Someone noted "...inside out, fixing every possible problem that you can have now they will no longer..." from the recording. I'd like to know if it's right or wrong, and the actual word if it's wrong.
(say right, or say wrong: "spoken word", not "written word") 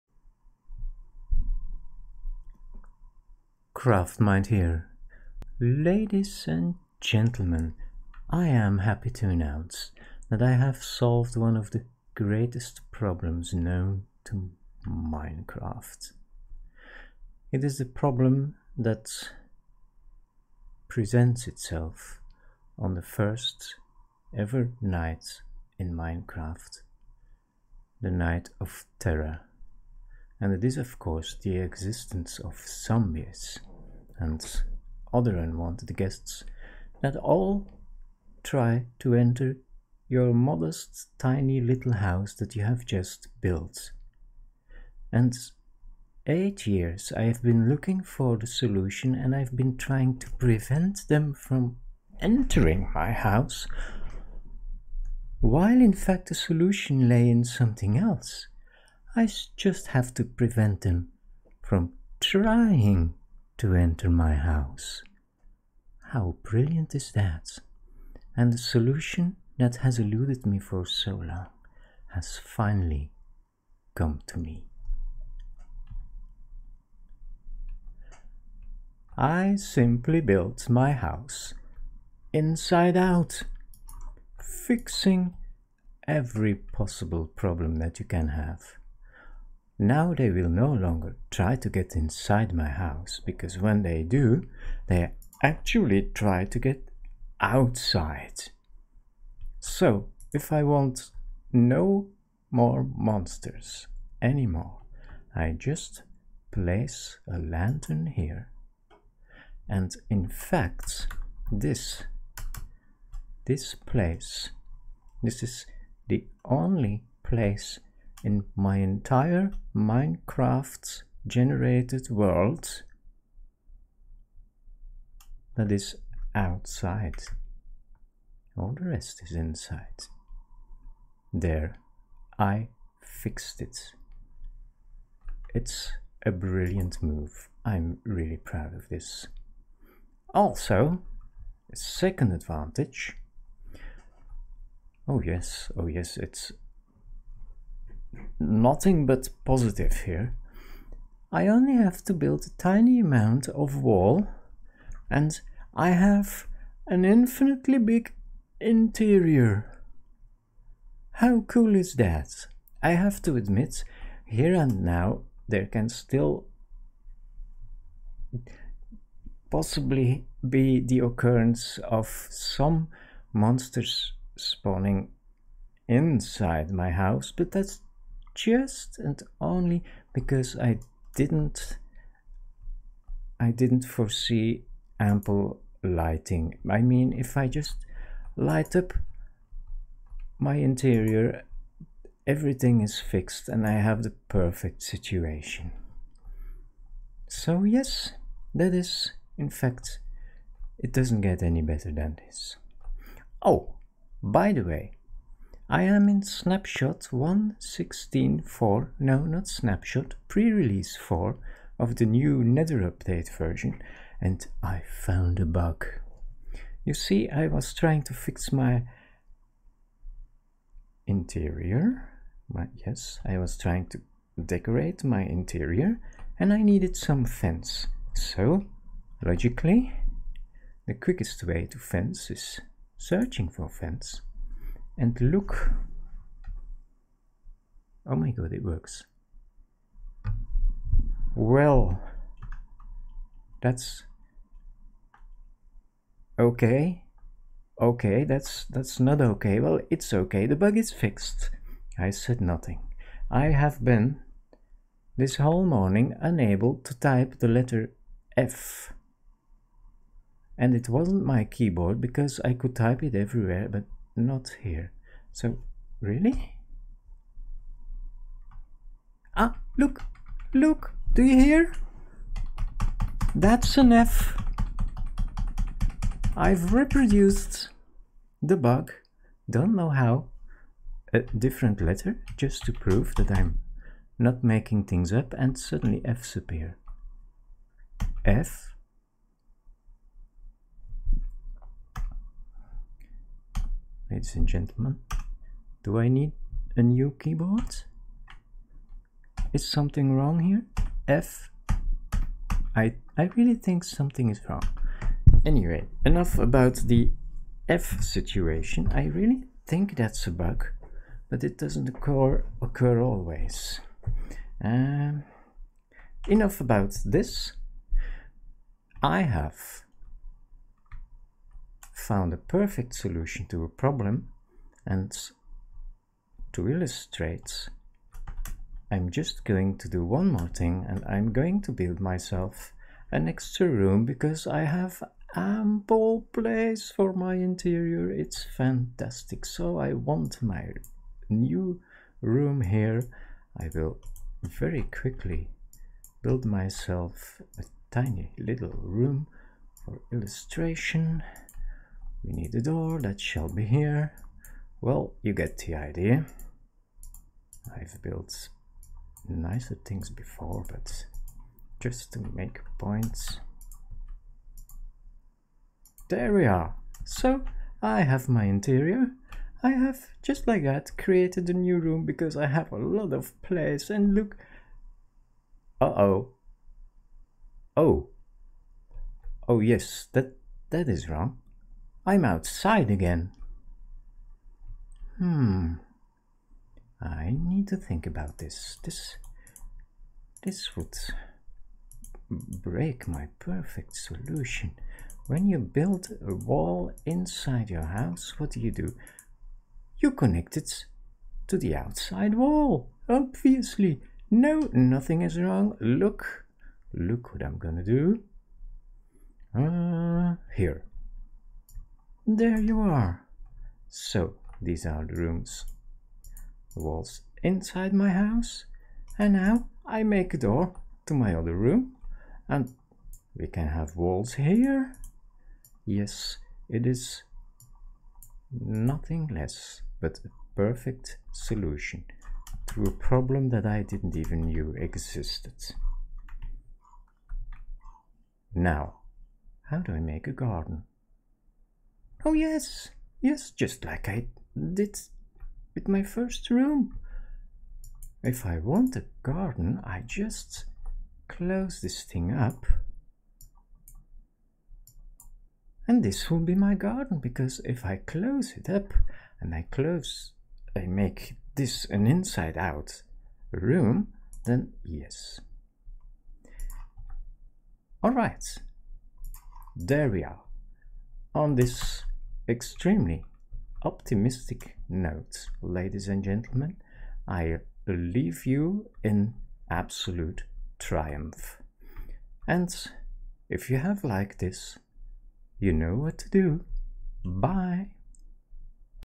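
right.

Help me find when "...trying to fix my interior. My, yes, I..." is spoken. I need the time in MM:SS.
03:37.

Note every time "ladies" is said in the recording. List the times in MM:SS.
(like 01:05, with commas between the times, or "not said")
00:05, 04:54, 07:55.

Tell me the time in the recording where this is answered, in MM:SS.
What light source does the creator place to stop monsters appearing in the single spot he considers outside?
01:47.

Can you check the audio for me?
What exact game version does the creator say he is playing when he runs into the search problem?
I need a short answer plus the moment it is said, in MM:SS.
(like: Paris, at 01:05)
1.16.4 pre-release 4, at 03:27.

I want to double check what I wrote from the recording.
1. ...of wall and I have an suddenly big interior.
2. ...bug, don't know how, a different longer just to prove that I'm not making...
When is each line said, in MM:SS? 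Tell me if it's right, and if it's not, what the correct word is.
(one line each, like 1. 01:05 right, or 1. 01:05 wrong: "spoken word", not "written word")
1. 02:33 wrong: "infinitely", not "suddenly"
2. 04:38 wrong: "letter", not "longer".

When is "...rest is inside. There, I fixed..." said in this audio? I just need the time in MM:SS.
02:08.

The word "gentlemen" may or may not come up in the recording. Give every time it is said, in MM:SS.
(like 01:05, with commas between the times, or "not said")
00:06, 04:54, 07:56.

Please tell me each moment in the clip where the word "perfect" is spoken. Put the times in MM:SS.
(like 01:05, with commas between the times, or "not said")
03:14, 05:22, 06:33, 07:10.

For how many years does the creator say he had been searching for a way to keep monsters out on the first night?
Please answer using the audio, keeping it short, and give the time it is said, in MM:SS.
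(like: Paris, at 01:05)
8, at 00:46.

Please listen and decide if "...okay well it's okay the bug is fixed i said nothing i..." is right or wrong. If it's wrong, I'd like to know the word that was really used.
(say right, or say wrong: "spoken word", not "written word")
right.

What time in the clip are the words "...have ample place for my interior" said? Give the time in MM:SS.
05:34.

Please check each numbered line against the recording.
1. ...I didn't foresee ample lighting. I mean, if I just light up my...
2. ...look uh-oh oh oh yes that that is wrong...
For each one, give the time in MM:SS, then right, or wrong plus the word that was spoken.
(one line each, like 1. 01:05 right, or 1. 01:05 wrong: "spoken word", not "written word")
1. 03:03 right
2. 06:14 right.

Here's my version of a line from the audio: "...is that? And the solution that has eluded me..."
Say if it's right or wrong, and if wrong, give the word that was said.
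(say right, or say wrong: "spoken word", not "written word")
right.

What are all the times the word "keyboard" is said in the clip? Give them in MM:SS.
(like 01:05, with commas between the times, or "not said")
04:21, 04:57.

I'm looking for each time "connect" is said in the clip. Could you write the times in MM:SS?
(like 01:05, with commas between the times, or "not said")
06:40.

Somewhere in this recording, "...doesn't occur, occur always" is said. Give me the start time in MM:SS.
05:11.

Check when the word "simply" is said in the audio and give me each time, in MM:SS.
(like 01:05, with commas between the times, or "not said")
01:19.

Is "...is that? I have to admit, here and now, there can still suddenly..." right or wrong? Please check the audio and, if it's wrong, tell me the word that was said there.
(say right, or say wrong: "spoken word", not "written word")
wrong: "possibly", not "suddenly".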